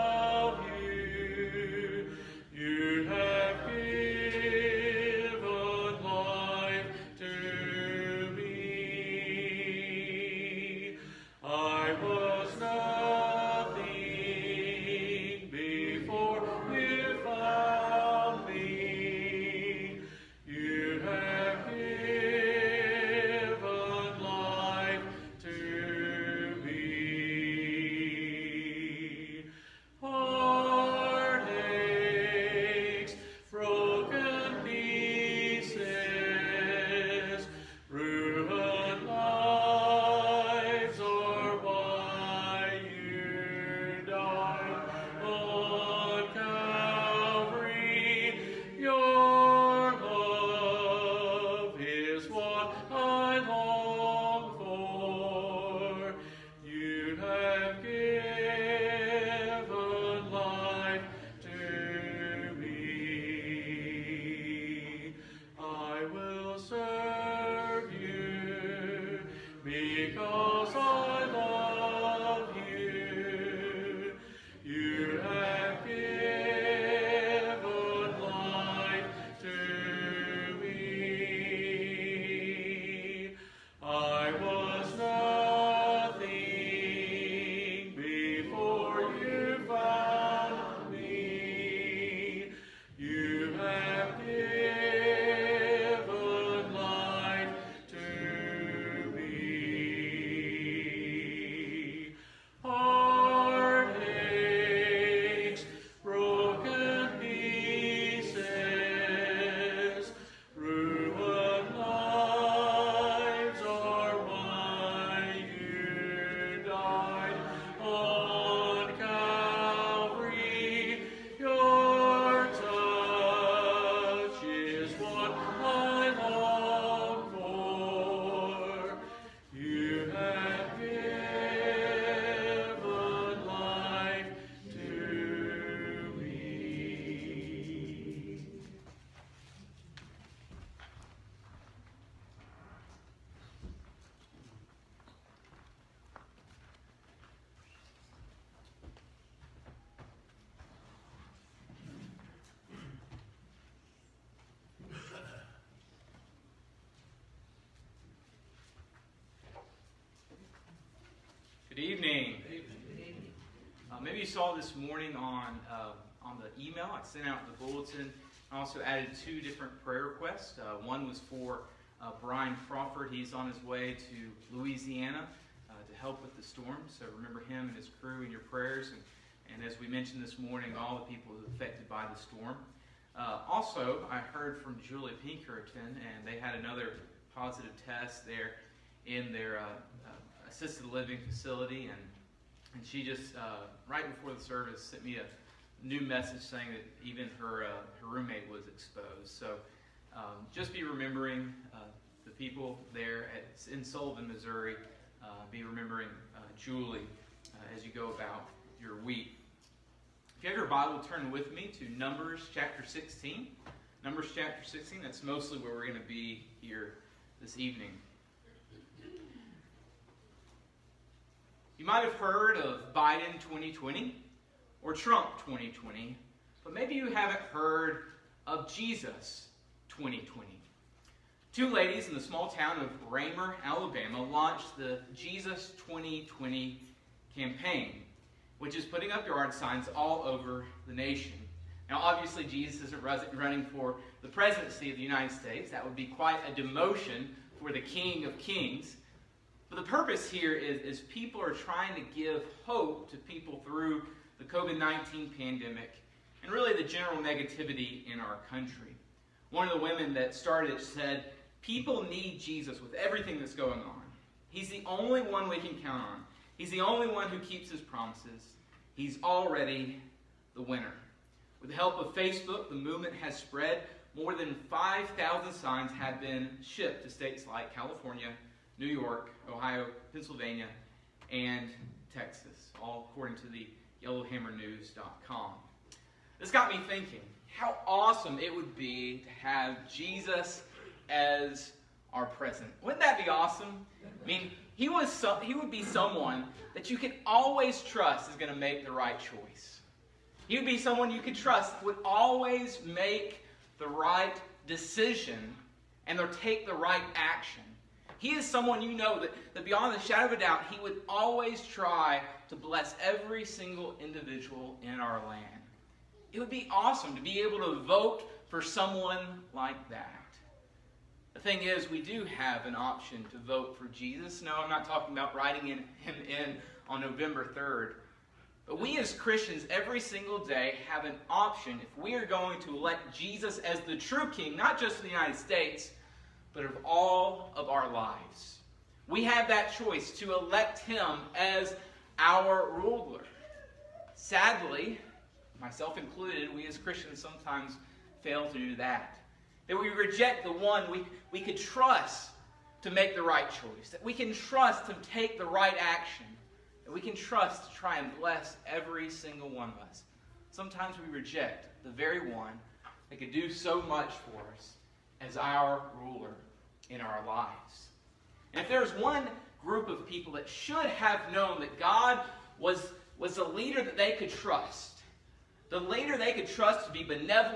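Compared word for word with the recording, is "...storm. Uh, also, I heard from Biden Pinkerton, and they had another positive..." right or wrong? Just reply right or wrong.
wrong.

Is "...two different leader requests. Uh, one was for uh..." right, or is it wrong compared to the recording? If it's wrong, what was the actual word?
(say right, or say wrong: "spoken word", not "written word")
wrong: "prayer", not "leader".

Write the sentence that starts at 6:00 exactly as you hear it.
Sometimes we reject the very one that could do so much for us as our ruler in our lives.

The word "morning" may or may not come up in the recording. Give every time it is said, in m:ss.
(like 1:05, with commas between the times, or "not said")
2:44, 3:00.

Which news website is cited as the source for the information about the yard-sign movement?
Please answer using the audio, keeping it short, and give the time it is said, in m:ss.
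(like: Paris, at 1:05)
yellowhammernews.com, at 4:44.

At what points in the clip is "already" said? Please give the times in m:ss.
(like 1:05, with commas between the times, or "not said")
4:29.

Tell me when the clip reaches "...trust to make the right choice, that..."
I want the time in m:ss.
5:51.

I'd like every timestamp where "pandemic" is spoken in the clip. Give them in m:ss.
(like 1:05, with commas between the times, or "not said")
4:15.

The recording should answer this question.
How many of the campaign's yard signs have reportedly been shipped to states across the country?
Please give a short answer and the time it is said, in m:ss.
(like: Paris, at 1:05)
More than 5,000, at 4:34.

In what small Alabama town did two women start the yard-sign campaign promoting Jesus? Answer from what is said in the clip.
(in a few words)
Raymer.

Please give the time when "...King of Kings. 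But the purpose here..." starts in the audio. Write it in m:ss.
4:07.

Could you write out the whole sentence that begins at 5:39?
We have that choice to elect him as our ruler.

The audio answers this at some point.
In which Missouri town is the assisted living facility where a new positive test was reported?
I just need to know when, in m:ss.
3:23.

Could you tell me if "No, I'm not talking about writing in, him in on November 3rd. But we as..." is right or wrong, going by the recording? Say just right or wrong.
right.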